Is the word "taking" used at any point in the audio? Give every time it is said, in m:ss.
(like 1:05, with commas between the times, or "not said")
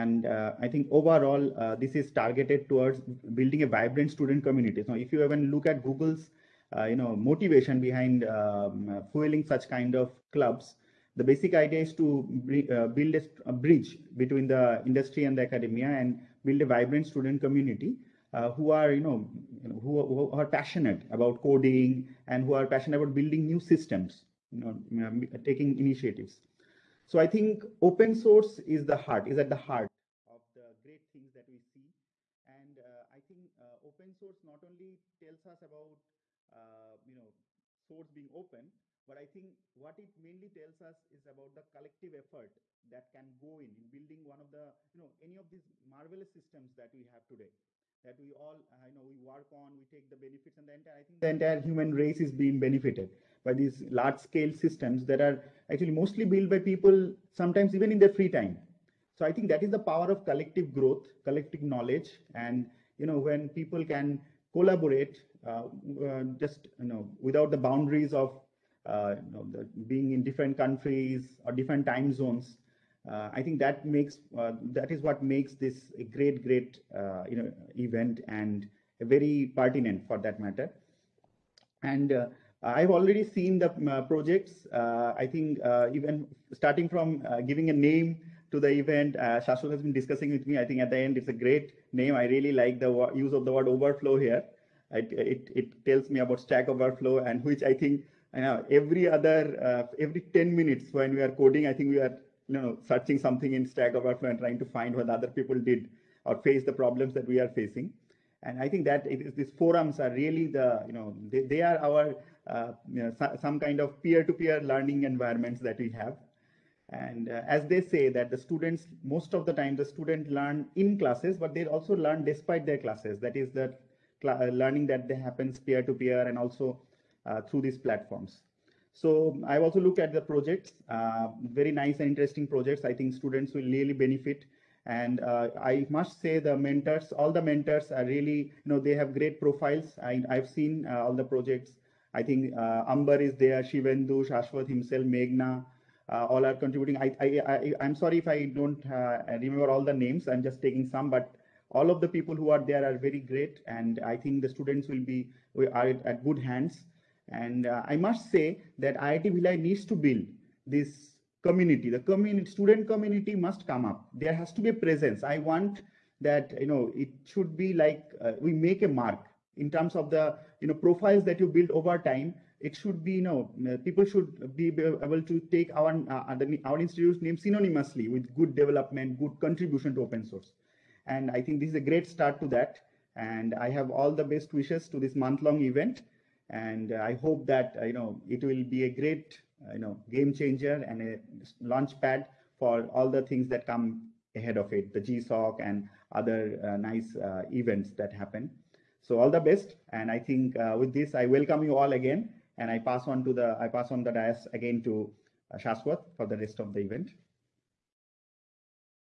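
0:25, 2:30.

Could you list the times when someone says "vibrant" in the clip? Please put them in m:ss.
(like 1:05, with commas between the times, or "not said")
0:03, 0:16.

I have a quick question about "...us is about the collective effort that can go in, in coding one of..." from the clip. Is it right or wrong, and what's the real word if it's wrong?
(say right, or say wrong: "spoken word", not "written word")
wrong: "building", not "coding".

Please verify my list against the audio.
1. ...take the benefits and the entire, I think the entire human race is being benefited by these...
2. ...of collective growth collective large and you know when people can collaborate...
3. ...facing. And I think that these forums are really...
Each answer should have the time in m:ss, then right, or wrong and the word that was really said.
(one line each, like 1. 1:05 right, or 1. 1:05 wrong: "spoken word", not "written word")
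1. 0:49 right
2. 1:00 wrong: "knowledge", not "large"
3. 1:47 right.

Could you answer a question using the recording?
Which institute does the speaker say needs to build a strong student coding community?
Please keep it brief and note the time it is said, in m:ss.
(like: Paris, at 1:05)
IIT Bhilai, at 2:38.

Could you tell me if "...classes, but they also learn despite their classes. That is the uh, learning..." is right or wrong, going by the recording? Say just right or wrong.
right.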